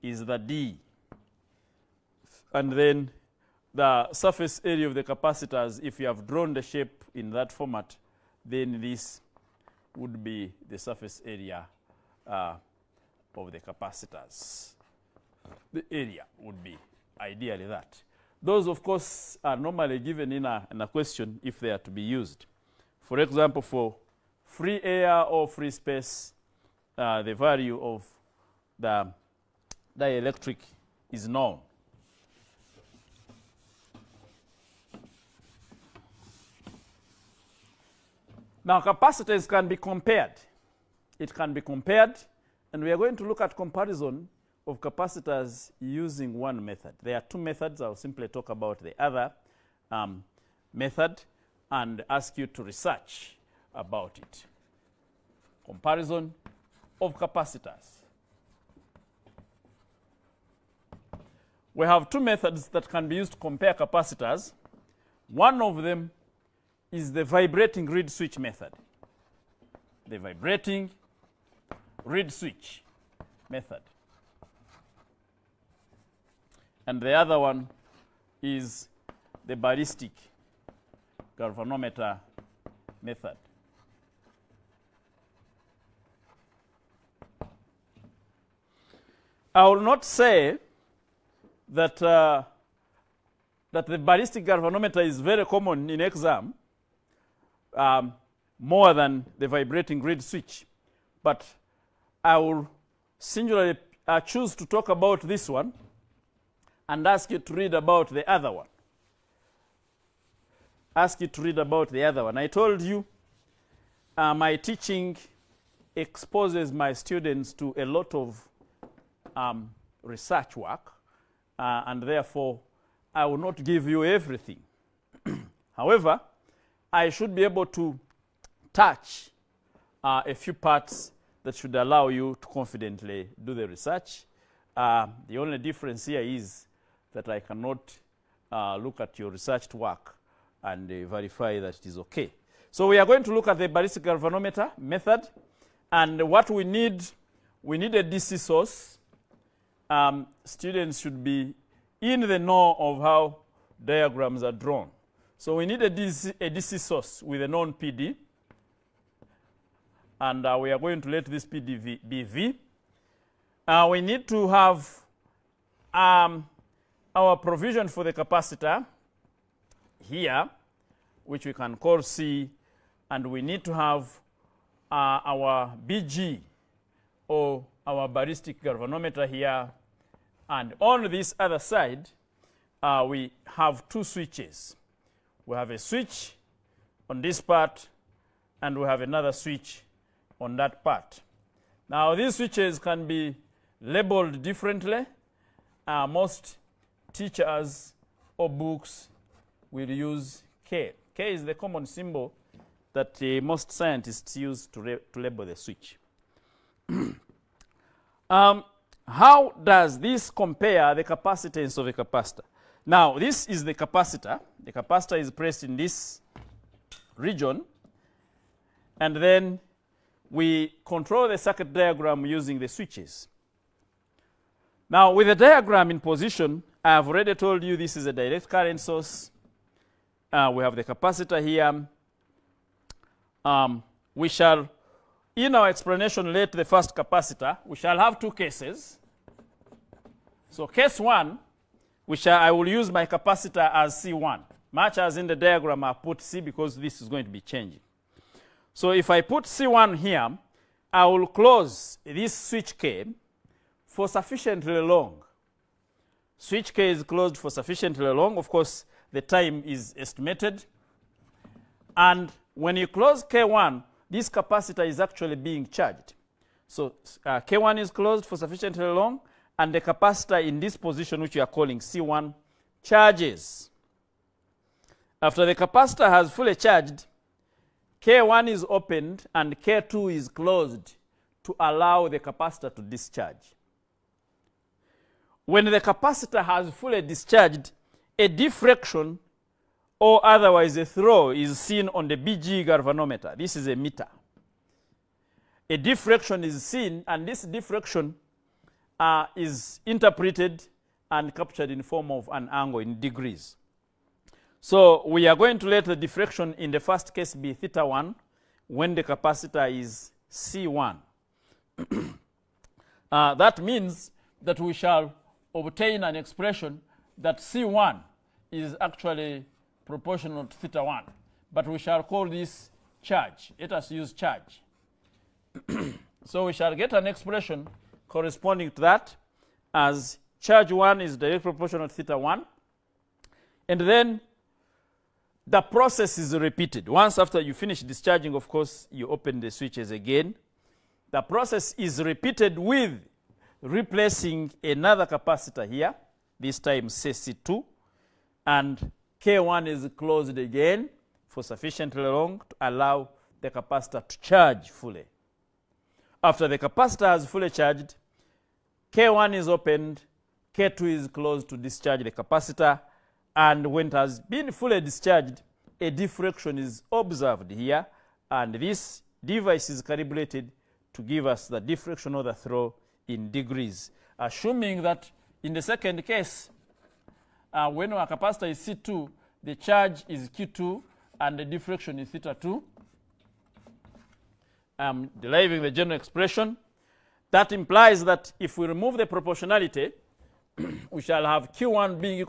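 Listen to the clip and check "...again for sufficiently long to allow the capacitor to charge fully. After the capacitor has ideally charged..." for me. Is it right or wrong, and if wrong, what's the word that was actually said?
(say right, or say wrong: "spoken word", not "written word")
wrong: "fully", not "ideally".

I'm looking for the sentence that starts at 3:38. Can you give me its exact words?
And then we control the circuit diagram using the switches.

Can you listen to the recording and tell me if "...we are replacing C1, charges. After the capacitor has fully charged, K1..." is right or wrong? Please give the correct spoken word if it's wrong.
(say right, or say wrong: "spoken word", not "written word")
wrong: "calling", not "replacing".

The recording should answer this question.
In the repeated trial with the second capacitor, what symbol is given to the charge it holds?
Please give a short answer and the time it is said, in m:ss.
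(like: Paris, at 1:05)
Q2, at 6:20.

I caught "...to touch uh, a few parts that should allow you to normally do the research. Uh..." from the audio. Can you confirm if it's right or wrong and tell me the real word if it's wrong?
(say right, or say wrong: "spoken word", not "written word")
wrong: "confidently", not "normally".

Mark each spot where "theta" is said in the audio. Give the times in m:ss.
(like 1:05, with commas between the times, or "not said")
5:07, 5:20, 5:31, 6:22.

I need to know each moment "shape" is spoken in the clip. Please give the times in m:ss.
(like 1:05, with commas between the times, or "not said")
0:06.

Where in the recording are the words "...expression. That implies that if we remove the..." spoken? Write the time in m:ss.
6:25.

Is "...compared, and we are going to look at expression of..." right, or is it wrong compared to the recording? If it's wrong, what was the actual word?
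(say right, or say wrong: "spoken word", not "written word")
wrong: "comparison", not "expression".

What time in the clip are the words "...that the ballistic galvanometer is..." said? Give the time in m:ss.
1:33.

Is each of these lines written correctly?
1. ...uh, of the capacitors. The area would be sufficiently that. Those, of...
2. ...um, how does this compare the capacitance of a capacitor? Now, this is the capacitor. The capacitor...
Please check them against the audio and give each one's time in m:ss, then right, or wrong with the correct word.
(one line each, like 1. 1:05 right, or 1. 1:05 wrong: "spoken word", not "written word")
1. 0:12 wrong: "ideally", not "sufficiently"
2. 3:28 right.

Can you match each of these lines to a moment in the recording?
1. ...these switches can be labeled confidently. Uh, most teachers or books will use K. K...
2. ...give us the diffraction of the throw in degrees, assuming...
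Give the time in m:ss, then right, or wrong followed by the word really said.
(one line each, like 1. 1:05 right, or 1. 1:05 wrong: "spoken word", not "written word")
1. 3:12 wrong: "differently", not "confidently"
2. 6:11 right.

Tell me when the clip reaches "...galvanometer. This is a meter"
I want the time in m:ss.
4:52.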